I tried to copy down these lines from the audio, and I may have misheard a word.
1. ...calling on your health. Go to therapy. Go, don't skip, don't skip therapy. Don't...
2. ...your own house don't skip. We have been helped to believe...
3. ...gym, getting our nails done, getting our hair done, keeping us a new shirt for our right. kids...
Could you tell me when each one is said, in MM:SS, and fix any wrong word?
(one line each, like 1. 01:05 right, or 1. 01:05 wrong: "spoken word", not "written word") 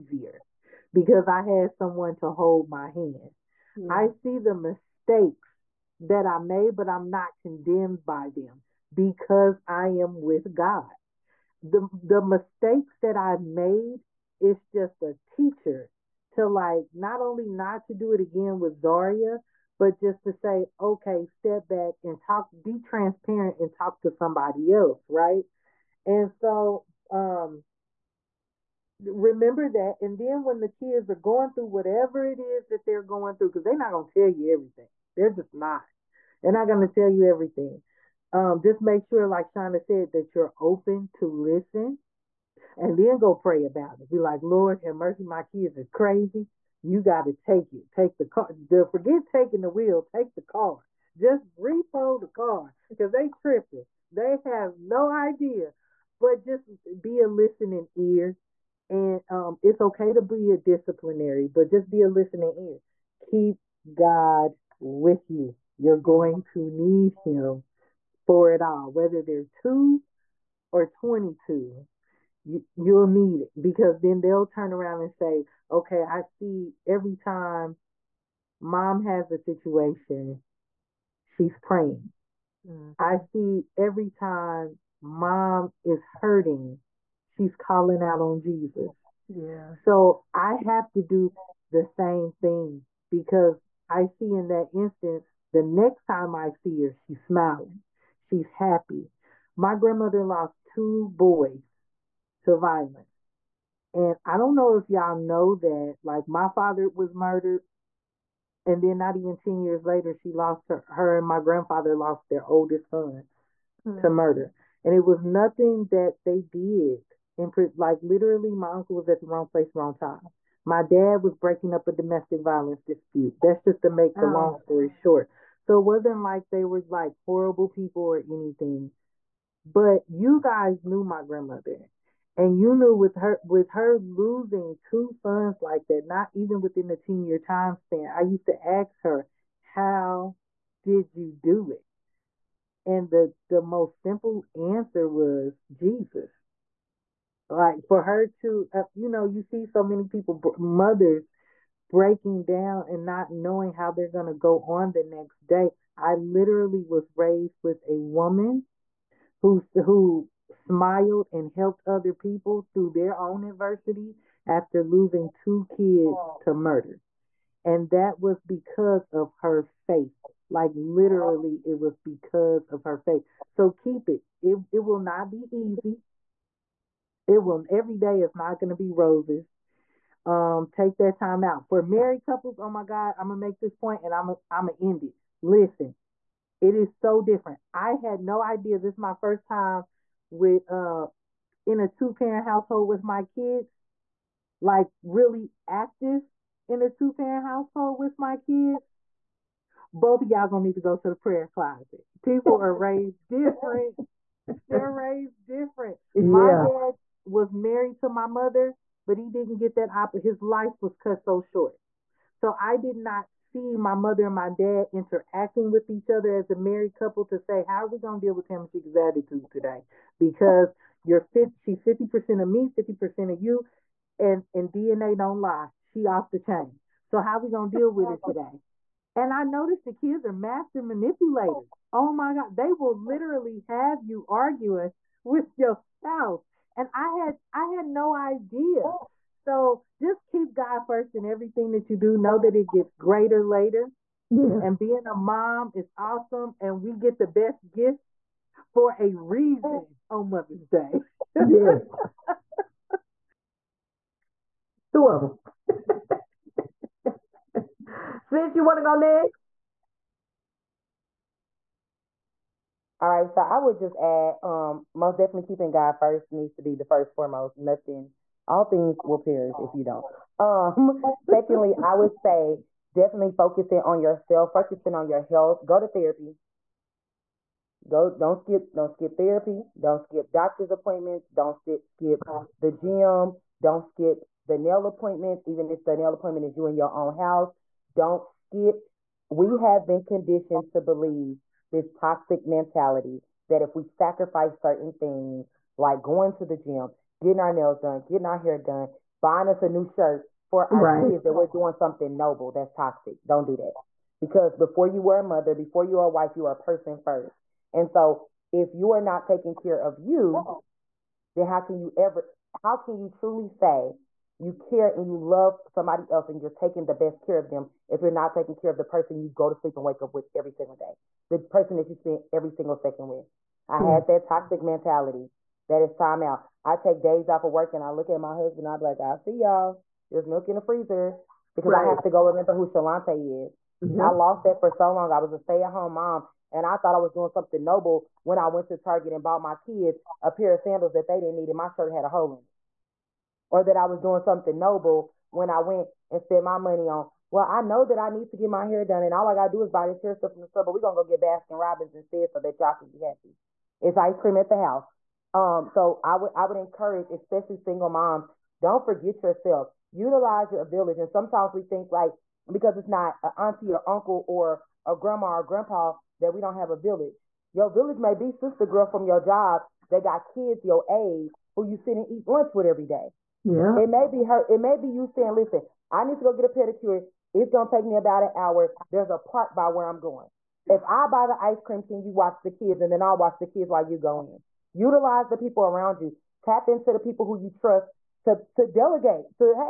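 1. 04:34 wrong: "focusing", not "calling"
2. 04:46 wrong: "conditioned", not "helped"
3. 04:56 wrong: "buying", not "keeping".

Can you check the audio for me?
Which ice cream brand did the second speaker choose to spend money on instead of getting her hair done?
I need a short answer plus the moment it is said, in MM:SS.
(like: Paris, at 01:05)
Baskin Robbins, at 05:51.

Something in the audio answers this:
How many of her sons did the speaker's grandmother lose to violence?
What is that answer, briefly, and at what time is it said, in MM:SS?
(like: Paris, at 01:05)
2, at 01:40.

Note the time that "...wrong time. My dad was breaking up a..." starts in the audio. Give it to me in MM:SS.
01:59.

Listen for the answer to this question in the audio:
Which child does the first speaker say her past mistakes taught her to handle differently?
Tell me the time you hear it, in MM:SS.
00:18.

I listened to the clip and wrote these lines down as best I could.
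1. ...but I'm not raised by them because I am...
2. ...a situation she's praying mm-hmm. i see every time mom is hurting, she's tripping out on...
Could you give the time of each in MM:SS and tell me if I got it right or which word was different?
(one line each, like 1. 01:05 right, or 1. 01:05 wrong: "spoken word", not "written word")
1. 00:06 wrong: "condemned", not "raised"
2. 01:19 wrong: "calling", not "tripping".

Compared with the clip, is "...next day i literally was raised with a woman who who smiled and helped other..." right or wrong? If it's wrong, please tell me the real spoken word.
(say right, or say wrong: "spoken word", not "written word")
right.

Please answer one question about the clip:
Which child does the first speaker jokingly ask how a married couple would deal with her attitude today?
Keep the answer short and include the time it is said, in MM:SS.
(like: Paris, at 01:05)
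Tamisha, at 03:38.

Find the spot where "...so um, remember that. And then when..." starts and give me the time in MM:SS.
00:26.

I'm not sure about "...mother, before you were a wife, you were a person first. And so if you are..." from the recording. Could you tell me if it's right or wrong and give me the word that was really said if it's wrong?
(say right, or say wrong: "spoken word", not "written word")
right.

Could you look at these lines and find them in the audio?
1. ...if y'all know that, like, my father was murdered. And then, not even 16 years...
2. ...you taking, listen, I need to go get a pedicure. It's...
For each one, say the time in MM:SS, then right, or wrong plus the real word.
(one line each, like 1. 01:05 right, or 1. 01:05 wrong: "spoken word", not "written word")
1. 01:44 wrong: "10", not "16"
2. 06:14 wrong: "saying", not "taking".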